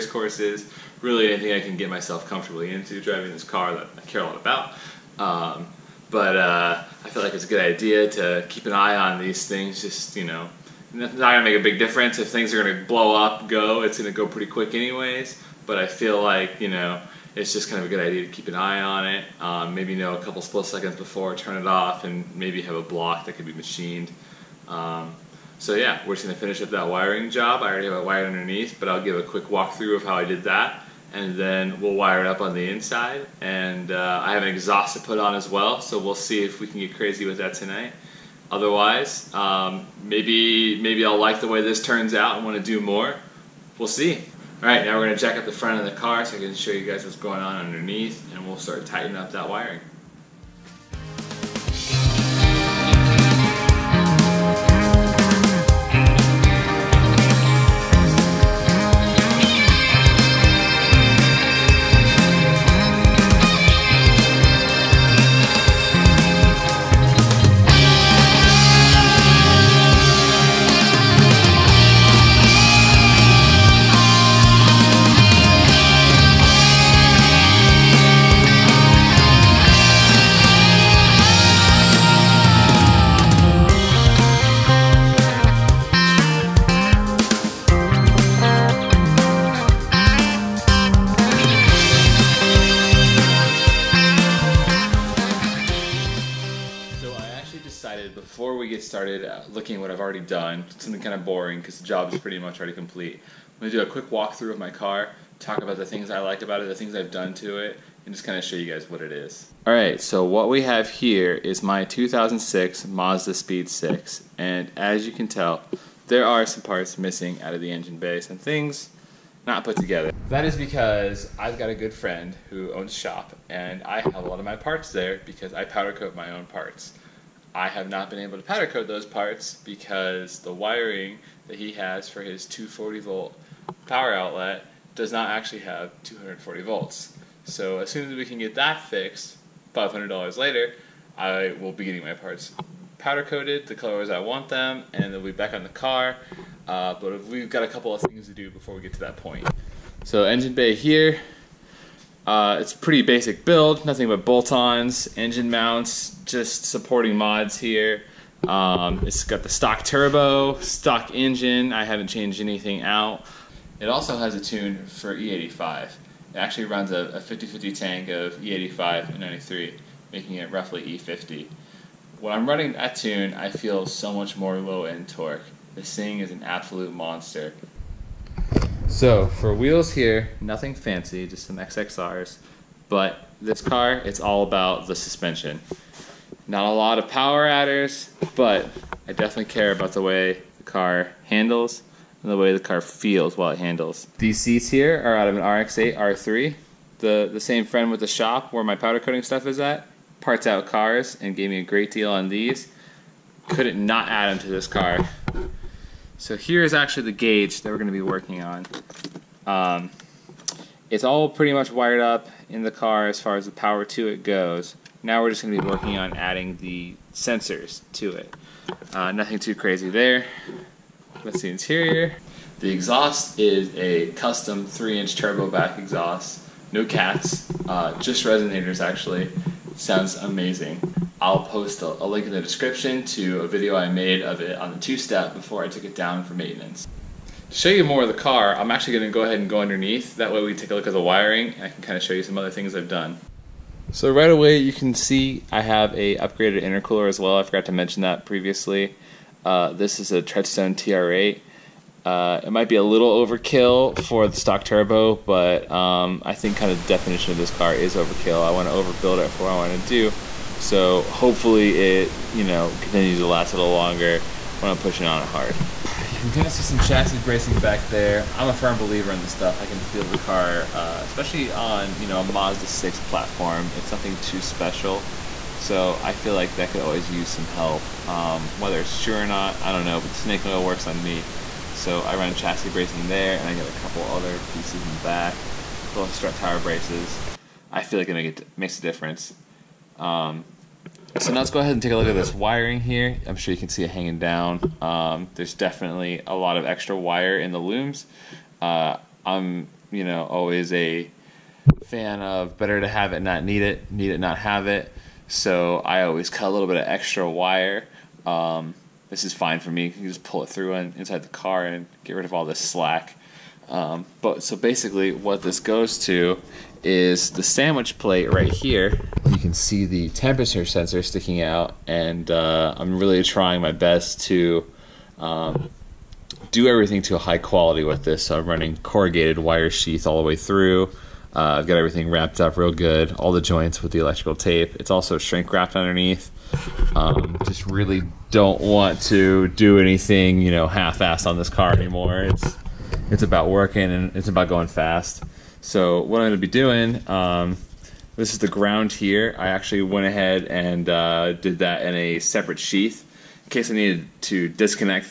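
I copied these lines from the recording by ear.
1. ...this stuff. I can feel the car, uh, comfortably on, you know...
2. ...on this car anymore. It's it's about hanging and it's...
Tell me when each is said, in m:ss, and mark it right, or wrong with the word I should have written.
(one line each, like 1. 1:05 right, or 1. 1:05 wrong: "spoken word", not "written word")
1. 4:29 wrong: "especially", not "comfortably"
2. 5:41 wrong: "working", not "hanging".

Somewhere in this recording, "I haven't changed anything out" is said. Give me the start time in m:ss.
2:41.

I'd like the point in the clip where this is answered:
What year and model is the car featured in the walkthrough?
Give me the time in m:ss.
1:51.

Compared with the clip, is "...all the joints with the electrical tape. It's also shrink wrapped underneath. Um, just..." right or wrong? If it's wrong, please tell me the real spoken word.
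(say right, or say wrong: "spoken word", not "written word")
right.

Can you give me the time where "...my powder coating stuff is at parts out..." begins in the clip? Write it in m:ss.
3:18.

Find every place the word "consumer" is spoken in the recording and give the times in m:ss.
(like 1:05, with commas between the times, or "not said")
not said.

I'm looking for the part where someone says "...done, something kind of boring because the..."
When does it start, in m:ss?
1:40.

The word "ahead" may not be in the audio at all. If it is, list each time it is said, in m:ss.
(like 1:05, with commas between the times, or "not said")
3:59, 4:51, 5:50.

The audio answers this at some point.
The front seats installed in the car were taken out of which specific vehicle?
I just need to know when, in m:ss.
3:15.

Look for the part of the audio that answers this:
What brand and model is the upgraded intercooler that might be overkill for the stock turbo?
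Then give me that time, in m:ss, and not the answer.
4:10.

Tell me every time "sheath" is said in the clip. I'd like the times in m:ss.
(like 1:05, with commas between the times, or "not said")
5:29, 5:52.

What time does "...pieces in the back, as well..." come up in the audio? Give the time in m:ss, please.
4:44.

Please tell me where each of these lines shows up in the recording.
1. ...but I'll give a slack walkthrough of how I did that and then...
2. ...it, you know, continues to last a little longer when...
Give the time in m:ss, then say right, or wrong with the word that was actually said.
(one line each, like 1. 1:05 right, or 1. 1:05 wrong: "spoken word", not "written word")
1. 0:28 wrong: "quick", not "slack"
2. 4:21 right.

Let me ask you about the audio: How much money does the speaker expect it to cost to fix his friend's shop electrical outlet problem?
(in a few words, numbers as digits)
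$500.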